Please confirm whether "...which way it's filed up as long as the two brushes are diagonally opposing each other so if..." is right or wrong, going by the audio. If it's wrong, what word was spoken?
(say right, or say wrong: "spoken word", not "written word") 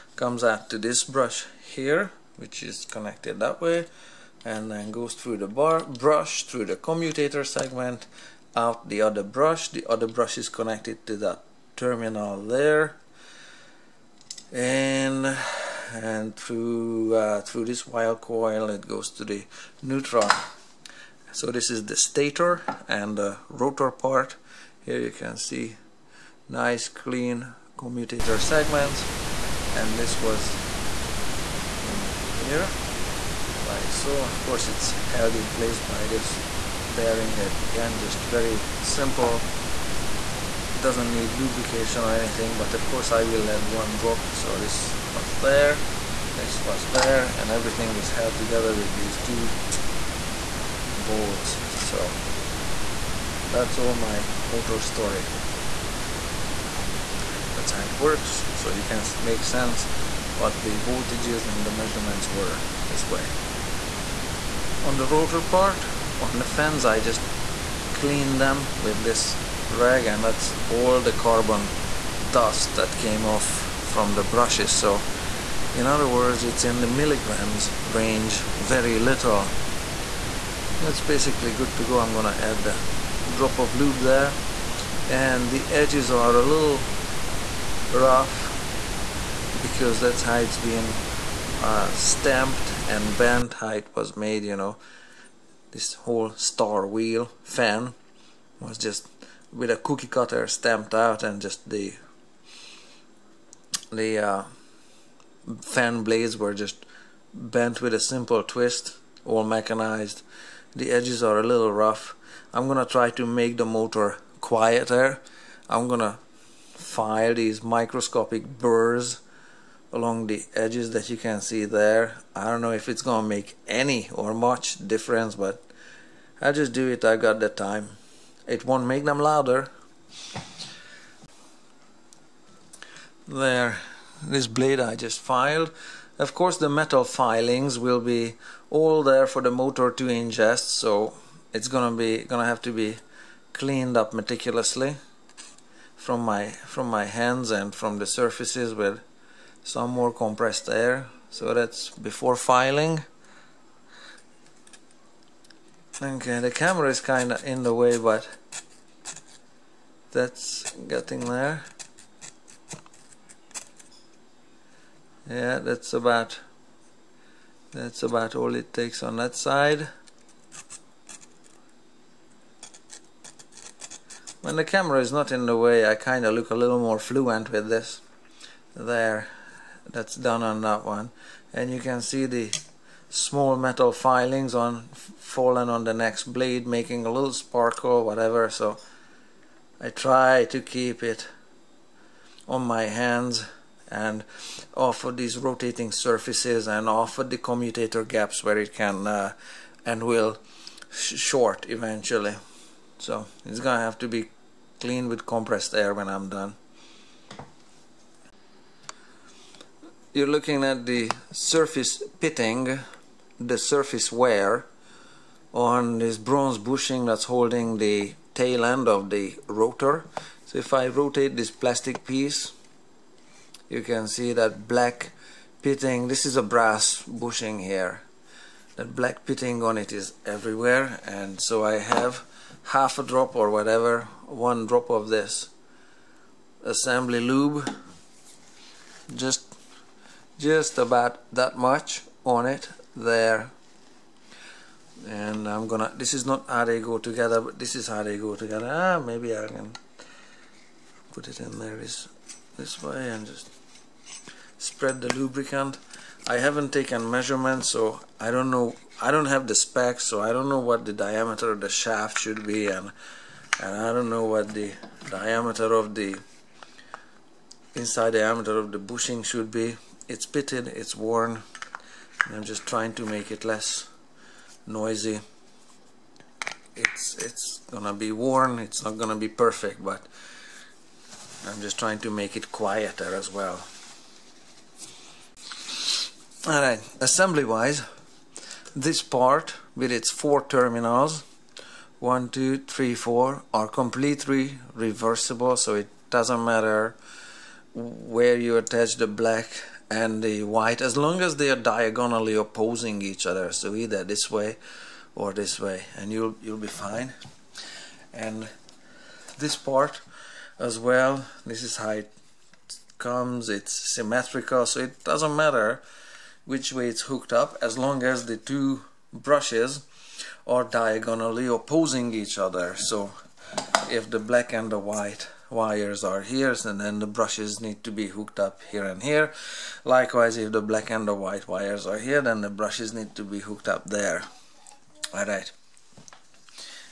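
wrong: "hooked", not "filed".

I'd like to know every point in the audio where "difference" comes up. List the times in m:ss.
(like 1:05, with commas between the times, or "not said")
2:04.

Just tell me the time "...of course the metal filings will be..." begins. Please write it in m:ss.
2:16.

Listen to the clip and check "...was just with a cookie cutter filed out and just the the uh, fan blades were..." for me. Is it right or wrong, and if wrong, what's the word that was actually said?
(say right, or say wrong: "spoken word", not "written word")
wrong: "stamped", not "filed".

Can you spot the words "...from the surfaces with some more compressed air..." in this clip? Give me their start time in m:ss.
2:27.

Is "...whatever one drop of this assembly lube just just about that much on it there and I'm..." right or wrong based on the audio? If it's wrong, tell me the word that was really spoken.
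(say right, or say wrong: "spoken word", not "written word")
right.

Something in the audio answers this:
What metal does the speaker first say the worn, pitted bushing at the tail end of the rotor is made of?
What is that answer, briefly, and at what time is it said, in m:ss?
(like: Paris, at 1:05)
bronze, at 3:36.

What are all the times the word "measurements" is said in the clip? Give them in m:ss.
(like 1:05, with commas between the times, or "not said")
1:01, 4:17.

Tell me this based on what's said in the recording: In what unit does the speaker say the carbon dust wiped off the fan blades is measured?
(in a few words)
milligrams.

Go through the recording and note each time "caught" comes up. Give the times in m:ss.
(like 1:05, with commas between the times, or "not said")
not said.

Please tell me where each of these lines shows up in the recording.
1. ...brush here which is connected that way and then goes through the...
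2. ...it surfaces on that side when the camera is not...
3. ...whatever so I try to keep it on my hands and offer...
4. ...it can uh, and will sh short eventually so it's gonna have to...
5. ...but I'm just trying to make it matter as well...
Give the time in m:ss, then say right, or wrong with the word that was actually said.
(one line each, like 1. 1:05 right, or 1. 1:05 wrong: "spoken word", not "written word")
1. 0:01 right
2. 2:48 wrong: "takes", not "surfaces"
3. 3:08 right
4. 3:18 right
5. 4:39 wrong: "quieter", not "matter".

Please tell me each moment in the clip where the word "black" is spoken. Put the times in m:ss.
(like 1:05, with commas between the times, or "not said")
3:44, 3:48, 4:59, 5:24, 5:30.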